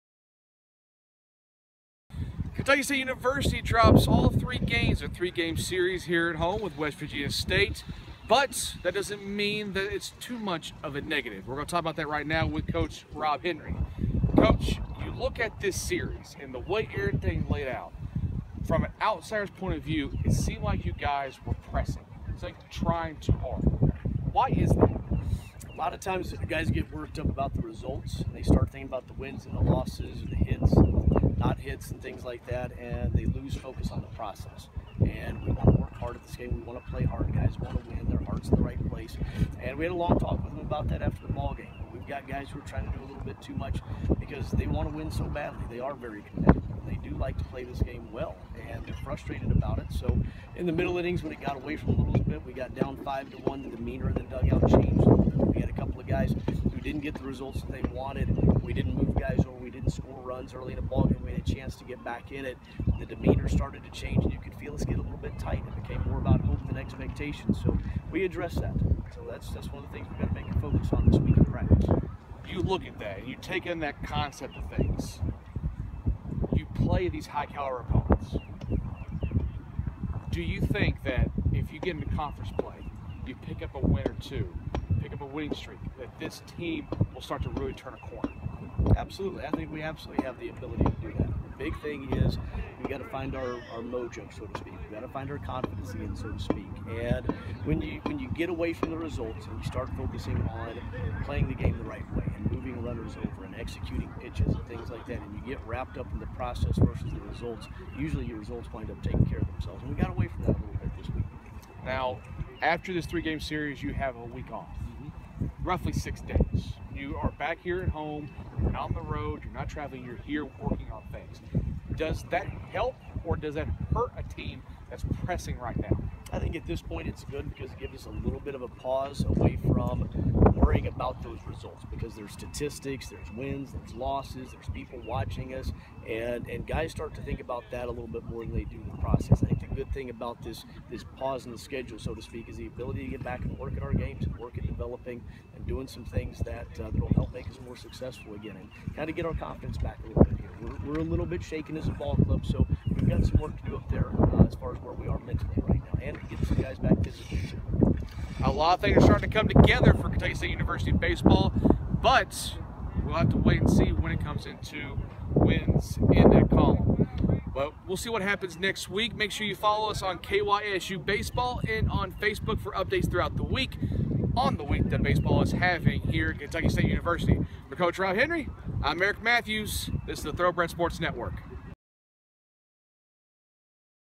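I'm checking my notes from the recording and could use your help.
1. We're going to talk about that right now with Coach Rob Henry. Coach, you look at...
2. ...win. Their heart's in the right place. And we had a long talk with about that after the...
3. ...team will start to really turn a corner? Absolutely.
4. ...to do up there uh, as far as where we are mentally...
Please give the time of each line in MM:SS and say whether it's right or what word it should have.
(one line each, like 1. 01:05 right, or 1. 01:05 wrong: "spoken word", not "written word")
1. 00:11 right
2. 00:37 right
3. 01:26 right
4. 02:33 right.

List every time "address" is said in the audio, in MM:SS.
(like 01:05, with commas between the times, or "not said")
01:08.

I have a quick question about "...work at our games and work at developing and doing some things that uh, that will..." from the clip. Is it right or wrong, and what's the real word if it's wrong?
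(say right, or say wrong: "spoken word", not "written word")
right.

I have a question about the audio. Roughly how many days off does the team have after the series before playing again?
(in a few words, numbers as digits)
6.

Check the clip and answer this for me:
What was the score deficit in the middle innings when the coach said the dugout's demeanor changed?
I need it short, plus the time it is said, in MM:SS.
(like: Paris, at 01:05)
5 to 1, at 00:53.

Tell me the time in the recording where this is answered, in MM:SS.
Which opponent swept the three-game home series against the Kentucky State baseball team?
00:06.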